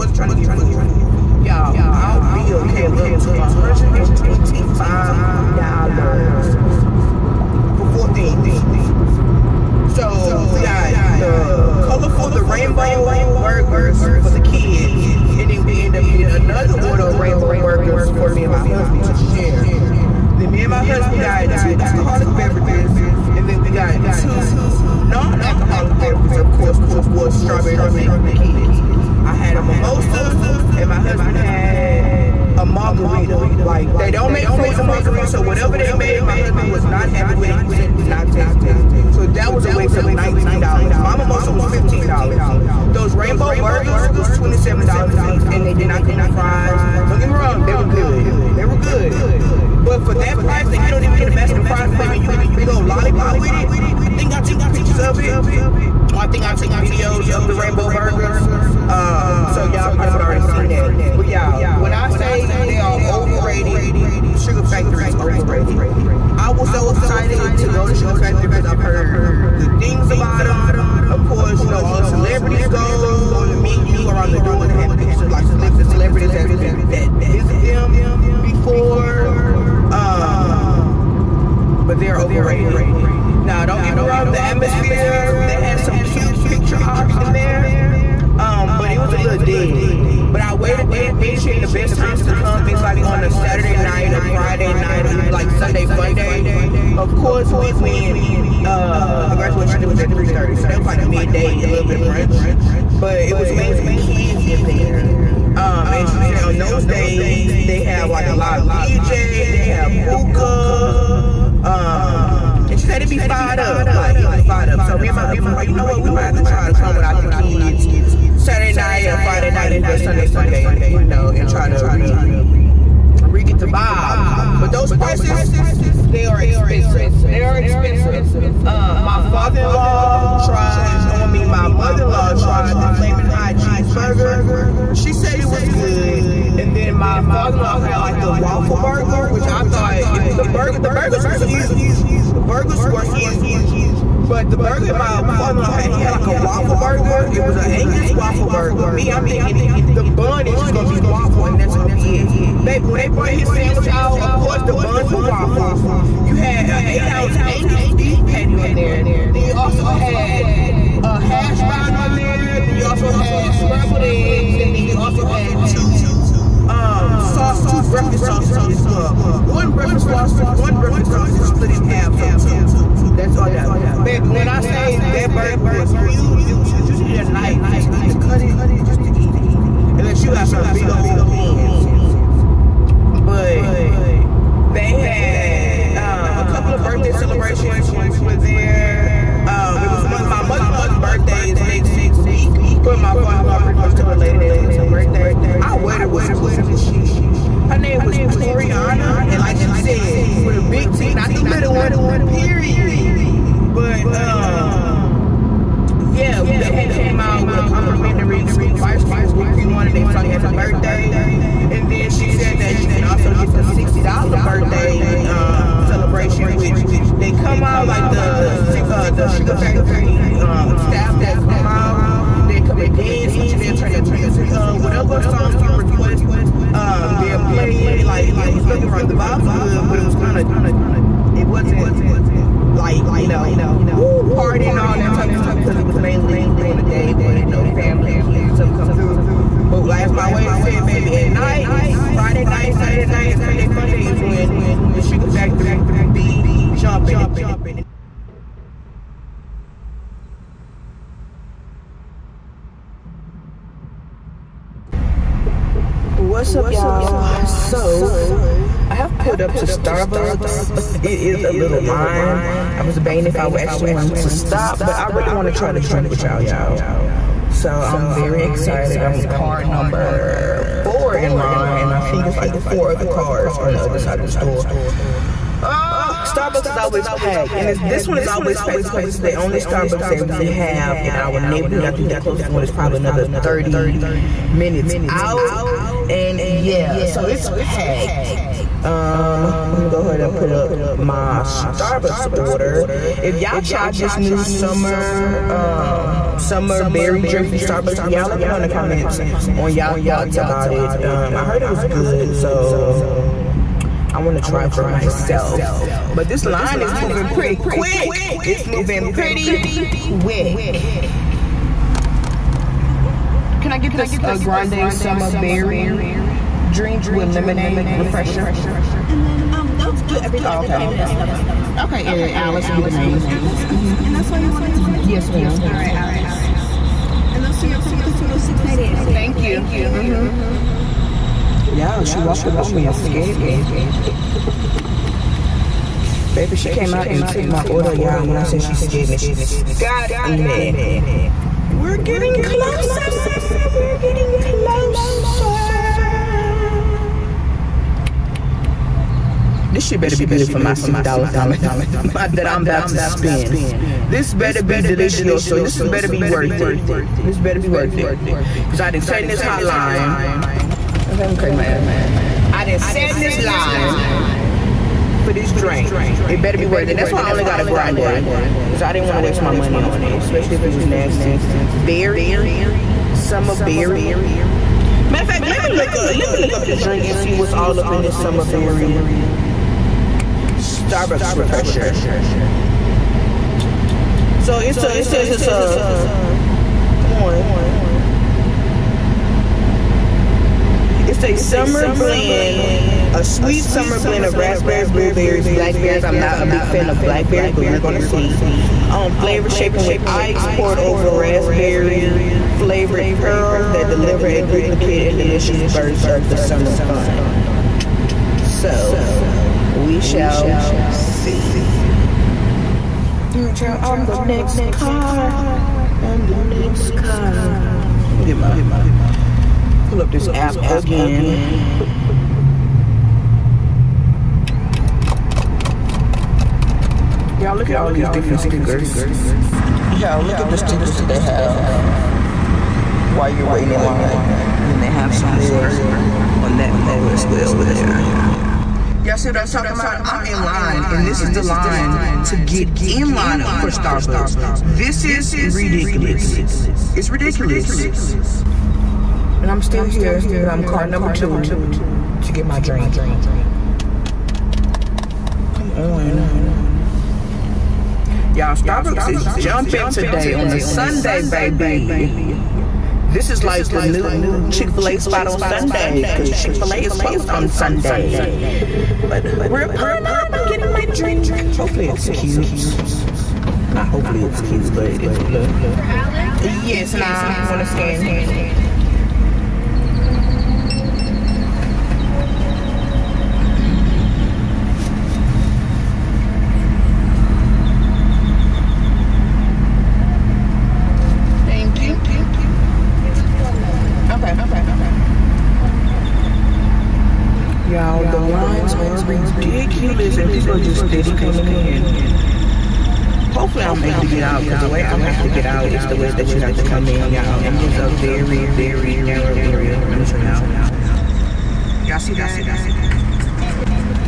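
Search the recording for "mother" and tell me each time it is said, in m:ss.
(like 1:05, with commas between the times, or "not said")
2:11, 3:10.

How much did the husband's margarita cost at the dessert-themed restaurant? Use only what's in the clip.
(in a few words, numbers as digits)
$19.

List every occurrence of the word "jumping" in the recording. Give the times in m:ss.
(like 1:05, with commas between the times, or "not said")
4:06, 7:39.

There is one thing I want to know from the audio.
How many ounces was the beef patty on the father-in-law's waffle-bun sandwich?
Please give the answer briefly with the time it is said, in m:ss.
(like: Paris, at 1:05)
8, at 2:36.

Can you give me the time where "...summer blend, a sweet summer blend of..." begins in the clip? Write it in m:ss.
6:31.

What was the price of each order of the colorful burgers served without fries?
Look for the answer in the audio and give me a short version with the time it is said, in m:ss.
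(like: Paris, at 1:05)
$27, at 0:44.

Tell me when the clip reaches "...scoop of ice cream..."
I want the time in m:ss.
3:28.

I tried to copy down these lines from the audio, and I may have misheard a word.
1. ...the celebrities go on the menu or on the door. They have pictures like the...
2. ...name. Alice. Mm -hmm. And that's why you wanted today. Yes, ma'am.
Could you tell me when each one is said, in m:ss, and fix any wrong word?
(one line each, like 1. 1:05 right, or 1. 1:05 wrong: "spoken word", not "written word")
1. 1:12 right
2. 5:23 right.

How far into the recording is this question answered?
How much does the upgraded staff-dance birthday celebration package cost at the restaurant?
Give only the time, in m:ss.
3:33.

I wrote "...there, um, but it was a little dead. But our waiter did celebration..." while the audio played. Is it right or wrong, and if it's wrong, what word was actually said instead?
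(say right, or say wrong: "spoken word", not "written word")
wrong: "mention", not "celebration".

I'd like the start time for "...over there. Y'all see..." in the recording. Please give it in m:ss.
7:17.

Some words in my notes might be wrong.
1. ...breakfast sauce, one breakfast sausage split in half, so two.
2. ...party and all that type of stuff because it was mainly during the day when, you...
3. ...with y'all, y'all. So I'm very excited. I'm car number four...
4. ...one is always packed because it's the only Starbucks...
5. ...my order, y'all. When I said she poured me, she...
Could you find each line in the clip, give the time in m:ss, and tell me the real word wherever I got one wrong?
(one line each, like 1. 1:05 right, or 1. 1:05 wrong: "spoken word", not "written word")
1. 2:49 right
2. 3:54 right
3. 4:26 right
4. 4:38 right
5. 5:37 wrong: "scared", not "poured".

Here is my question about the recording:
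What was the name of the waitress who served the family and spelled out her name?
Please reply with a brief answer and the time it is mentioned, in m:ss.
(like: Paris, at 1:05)
Toriana, at 3:18.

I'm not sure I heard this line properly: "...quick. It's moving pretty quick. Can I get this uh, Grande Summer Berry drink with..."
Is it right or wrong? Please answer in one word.
right.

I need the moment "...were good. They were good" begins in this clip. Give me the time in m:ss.
0:47.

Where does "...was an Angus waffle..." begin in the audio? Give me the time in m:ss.
2:27.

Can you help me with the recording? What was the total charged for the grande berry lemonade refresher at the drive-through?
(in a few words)
$6.98.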